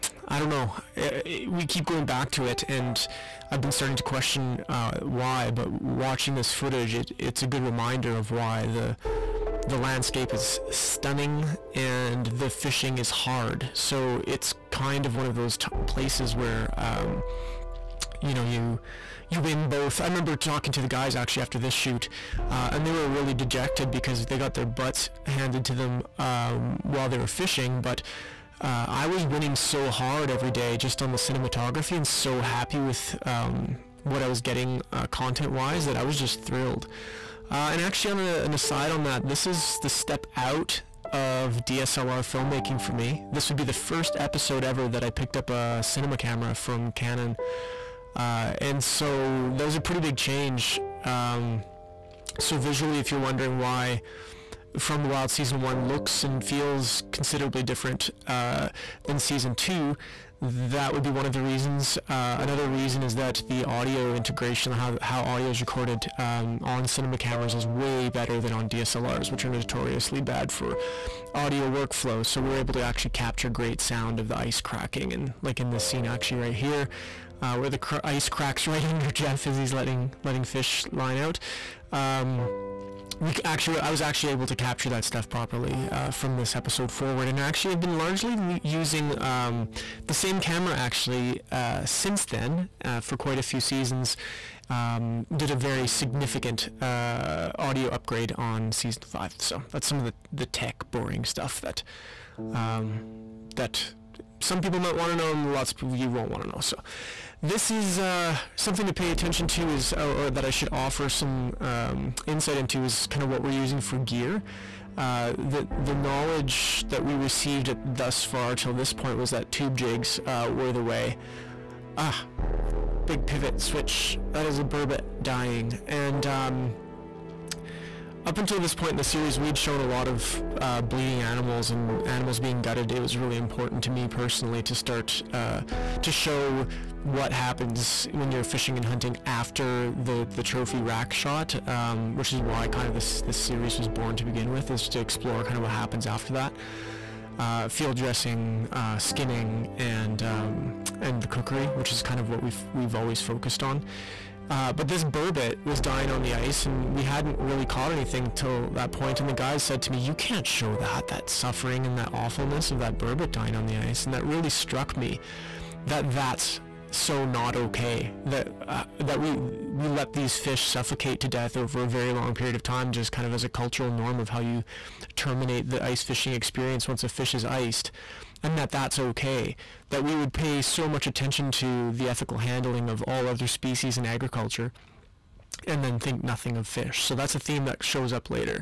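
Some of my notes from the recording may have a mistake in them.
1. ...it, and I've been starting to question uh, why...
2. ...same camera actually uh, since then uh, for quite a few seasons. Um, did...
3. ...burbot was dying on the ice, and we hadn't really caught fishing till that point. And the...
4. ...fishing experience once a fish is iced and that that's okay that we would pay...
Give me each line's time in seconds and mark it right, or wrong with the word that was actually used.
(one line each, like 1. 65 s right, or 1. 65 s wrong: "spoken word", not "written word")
1. 2 s right
2. 90 s right
3. 155 s wrong: "anything", not "fishing"
4. 176 s right.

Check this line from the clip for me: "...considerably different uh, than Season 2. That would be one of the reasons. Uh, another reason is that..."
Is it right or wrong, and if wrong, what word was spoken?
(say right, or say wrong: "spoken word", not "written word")
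right.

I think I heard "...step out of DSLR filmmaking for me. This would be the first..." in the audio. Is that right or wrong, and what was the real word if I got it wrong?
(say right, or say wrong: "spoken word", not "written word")
right.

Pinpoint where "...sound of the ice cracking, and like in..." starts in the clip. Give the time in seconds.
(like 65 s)
73 s.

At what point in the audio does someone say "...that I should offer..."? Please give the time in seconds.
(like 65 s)
110 s.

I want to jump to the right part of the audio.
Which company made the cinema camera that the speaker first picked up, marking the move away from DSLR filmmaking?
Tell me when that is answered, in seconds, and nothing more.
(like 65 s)
46 s.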